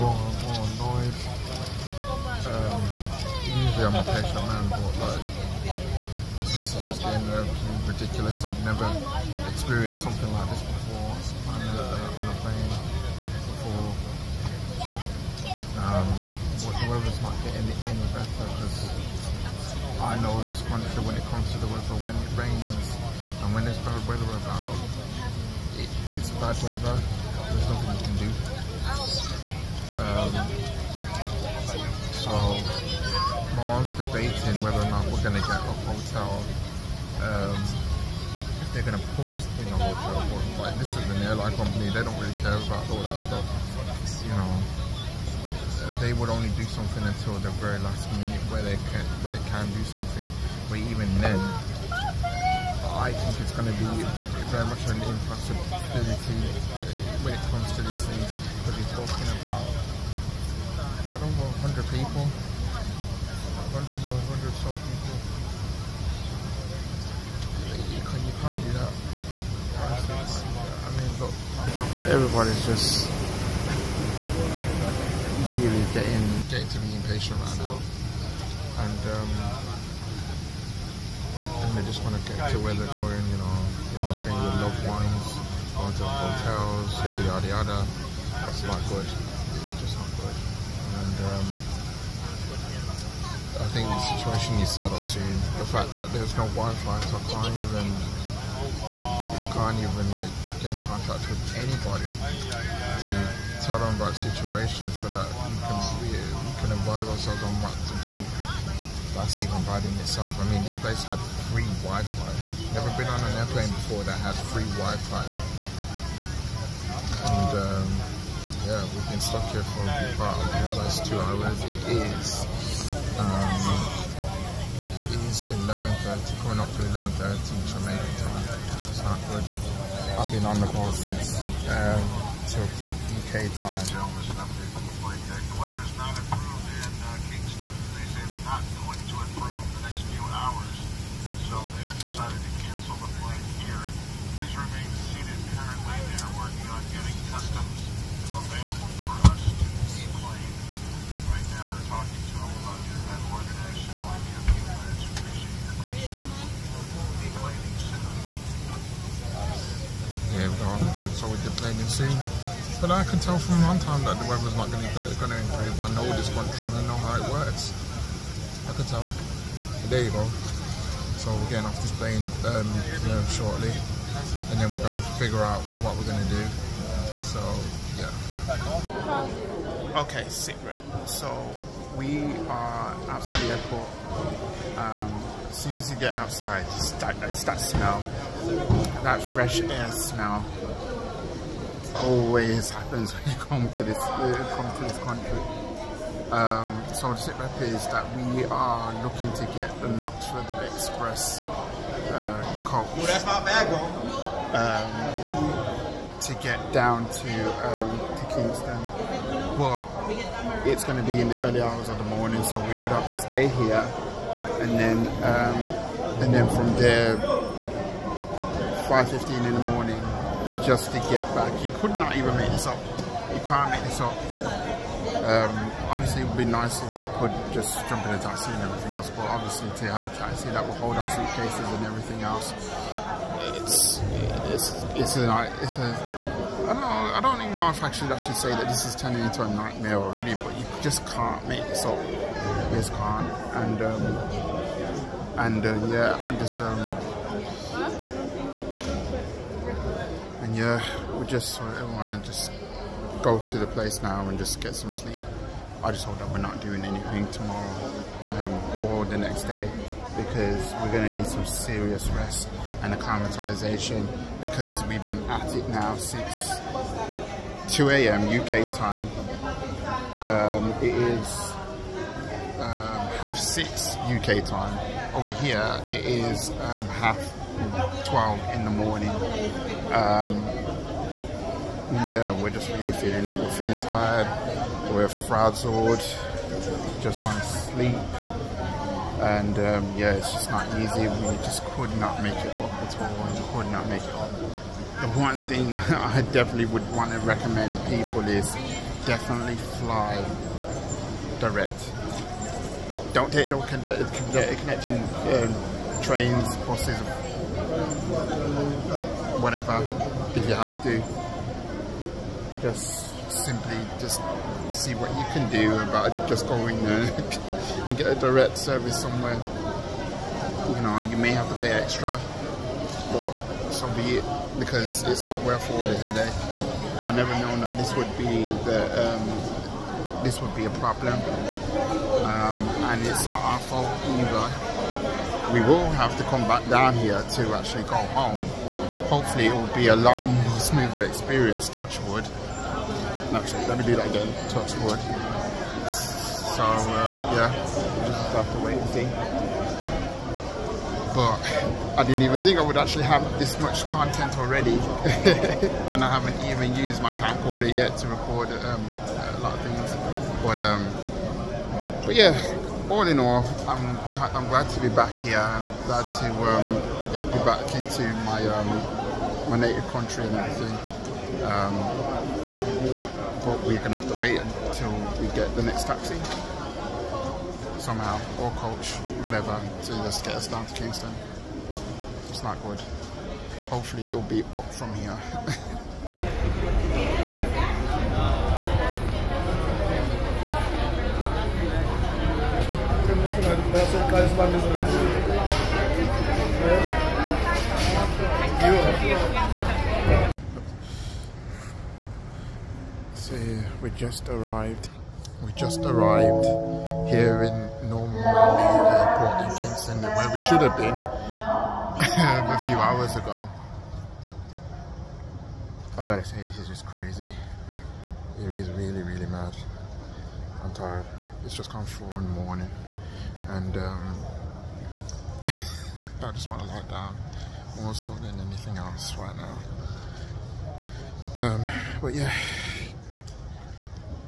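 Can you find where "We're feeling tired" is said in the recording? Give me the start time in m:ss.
4:43.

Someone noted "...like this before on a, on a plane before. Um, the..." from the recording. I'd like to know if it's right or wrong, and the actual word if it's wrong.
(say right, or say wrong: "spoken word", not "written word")
right.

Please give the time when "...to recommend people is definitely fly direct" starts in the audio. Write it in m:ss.
4:57.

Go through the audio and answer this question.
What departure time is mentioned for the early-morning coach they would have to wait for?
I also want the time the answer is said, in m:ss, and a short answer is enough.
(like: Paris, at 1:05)
5:15, at 3:38.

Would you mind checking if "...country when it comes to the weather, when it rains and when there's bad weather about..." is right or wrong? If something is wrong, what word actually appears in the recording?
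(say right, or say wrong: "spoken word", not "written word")
right.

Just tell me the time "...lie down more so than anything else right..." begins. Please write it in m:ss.
7:06.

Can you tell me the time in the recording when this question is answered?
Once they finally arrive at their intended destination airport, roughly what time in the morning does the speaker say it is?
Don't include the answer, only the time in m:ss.
7:01.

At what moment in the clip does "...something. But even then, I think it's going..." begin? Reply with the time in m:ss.
0:49.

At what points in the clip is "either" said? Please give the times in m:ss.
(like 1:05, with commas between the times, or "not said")
5:34.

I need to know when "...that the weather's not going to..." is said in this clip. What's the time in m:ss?
2:44.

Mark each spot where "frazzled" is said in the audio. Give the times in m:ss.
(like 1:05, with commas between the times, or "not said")
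4:45.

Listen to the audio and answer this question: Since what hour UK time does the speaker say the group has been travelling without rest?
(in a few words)
2 a.m.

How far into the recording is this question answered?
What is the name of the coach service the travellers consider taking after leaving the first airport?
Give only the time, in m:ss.
3:19.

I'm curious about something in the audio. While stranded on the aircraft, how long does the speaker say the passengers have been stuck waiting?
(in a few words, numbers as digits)
2 hours.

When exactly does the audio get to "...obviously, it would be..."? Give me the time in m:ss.
3:45.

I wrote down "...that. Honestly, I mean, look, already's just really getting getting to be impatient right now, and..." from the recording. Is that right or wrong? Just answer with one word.
wrong.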